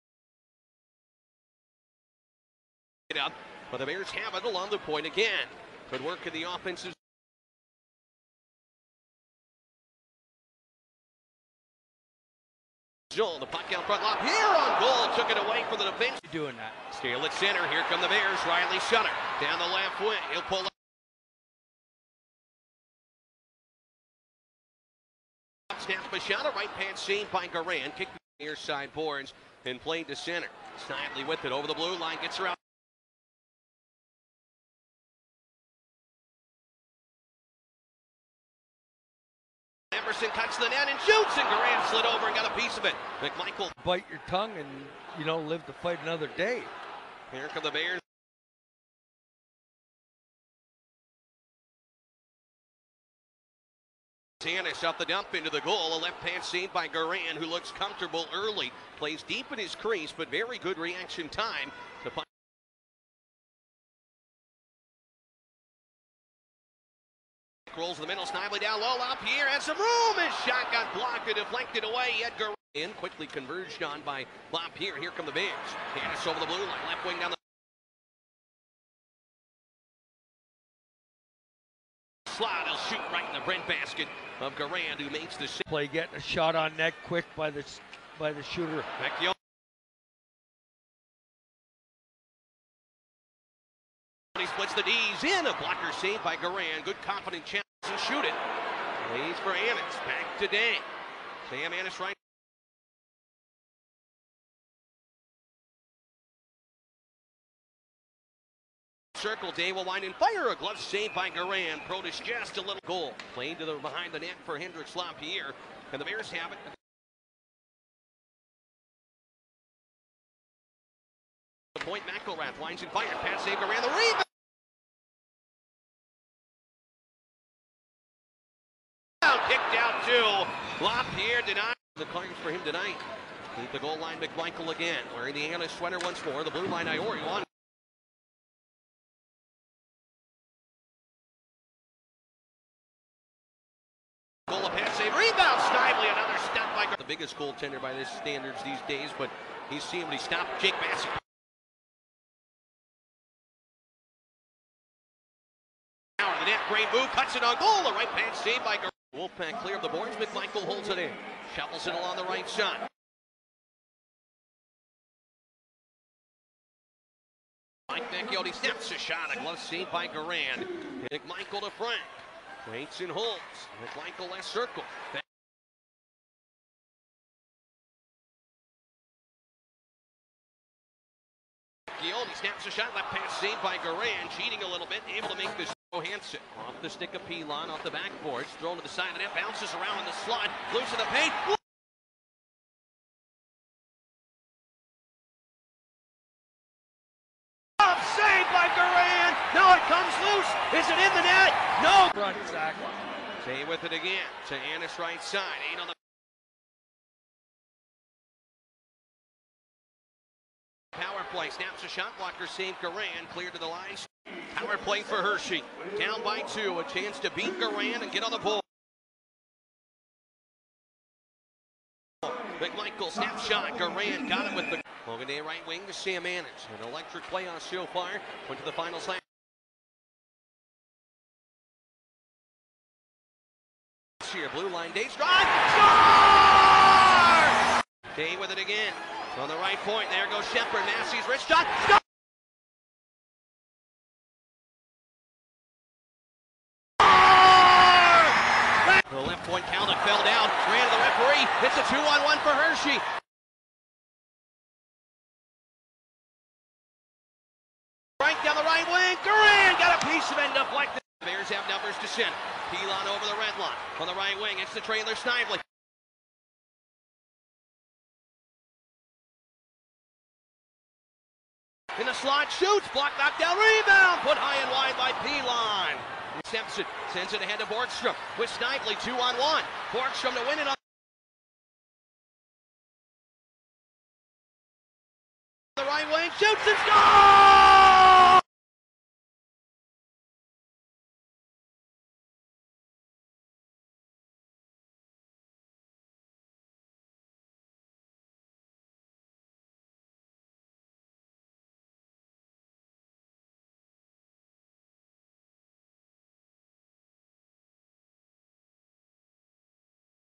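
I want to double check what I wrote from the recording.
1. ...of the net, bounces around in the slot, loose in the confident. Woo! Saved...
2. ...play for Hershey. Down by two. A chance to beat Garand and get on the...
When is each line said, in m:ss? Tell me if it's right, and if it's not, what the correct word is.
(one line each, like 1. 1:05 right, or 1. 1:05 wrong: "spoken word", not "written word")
1. 3:09 wrong: "paint", not "confident"
2. 3:34 right.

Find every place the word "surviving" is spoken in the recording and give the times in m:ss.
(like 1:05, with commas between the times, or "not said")
not said.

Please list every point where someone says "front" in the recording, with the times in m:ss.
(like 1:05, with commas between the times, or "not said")
0:13.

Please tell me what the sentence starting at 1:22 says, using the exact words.
He'll shoot right in the Brent basket of Garand, who makes the play.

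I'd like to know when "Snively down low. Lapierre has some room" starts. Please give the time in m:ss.
1:08.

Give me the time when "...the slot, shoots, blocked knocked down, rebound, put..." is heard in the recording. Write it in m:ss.
4:32.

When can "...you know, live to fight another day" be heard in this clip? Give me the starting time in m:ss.
0:45.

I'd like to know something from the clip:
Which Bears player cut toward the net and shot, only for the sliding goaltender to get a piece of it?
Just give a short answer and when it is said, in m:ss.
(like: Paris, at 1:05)
Iverson, at 0:40.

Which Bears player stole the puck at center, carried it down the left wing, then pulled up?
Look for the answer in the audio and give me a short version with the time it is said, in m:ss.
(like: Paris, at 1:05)
Riley Sutter, at 0:18.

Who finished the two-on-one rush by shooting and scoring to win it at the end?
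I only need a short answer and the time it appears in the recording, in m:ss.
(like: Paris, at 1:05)
Williams, at 4:46.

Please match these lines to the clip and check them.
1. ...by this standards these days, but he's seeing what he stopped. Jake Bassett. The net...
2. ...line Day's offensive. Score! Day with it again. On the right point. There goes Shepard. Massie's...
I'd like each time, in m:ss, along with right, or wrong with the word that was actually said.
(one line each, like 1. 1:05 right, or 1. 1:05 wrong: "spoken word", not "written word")
1. 2:27 right
2. 3:54 wrong: "drive", not "offensive".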